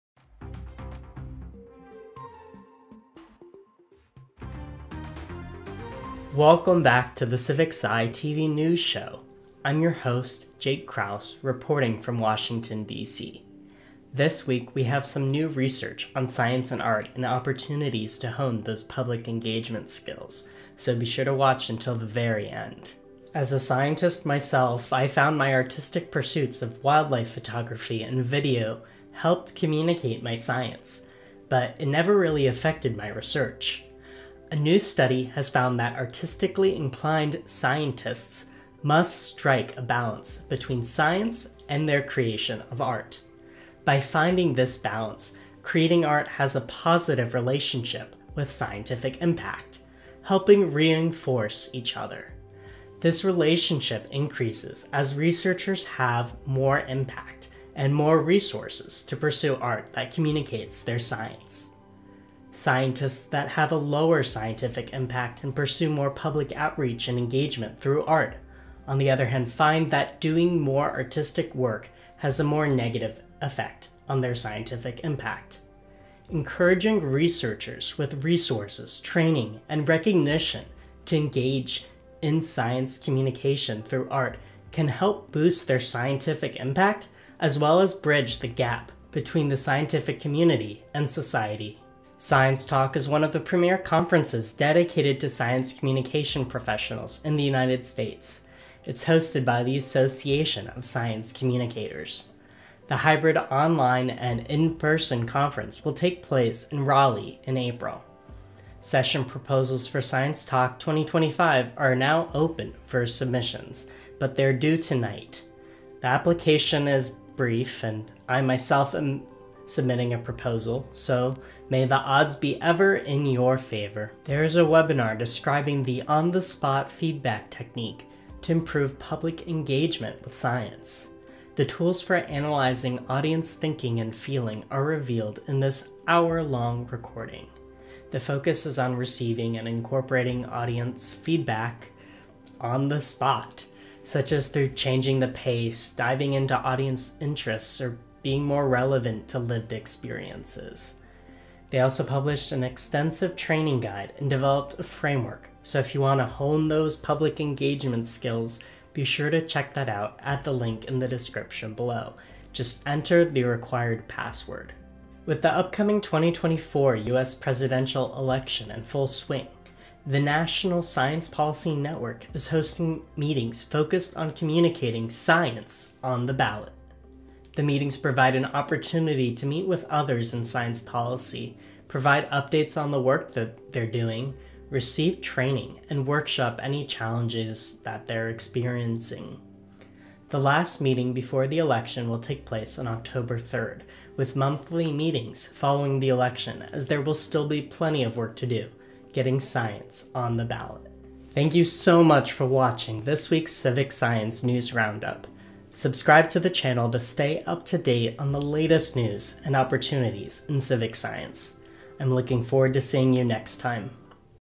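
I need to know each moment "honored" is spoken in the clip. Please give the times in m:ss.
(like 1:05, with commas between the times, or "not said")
not said.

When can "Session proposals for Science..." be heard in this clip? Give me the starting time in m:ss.
1:48.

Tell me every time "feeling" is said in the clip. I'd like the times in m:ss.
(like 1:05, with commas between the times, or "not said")
2:14.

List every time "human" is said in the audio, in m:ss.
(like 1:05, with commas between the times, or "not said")
not said.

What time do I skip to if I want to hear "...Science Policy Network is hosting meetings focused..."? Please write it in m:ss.
2:50.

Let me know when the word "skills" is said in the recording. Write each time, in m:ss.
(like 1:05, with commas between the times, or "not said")
0:19, 2:38.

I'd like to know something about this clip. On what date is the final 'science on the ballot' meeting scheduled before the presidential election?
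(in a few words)
October 3rd.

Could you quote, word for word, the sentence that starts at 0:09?
I'm your host, Jake Krauss, reporting from Washington, D.C.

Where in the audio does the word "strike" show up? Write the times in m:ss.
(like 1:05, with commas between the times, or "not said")
0:39.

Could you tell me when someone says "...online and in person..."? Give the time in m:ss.
1:43.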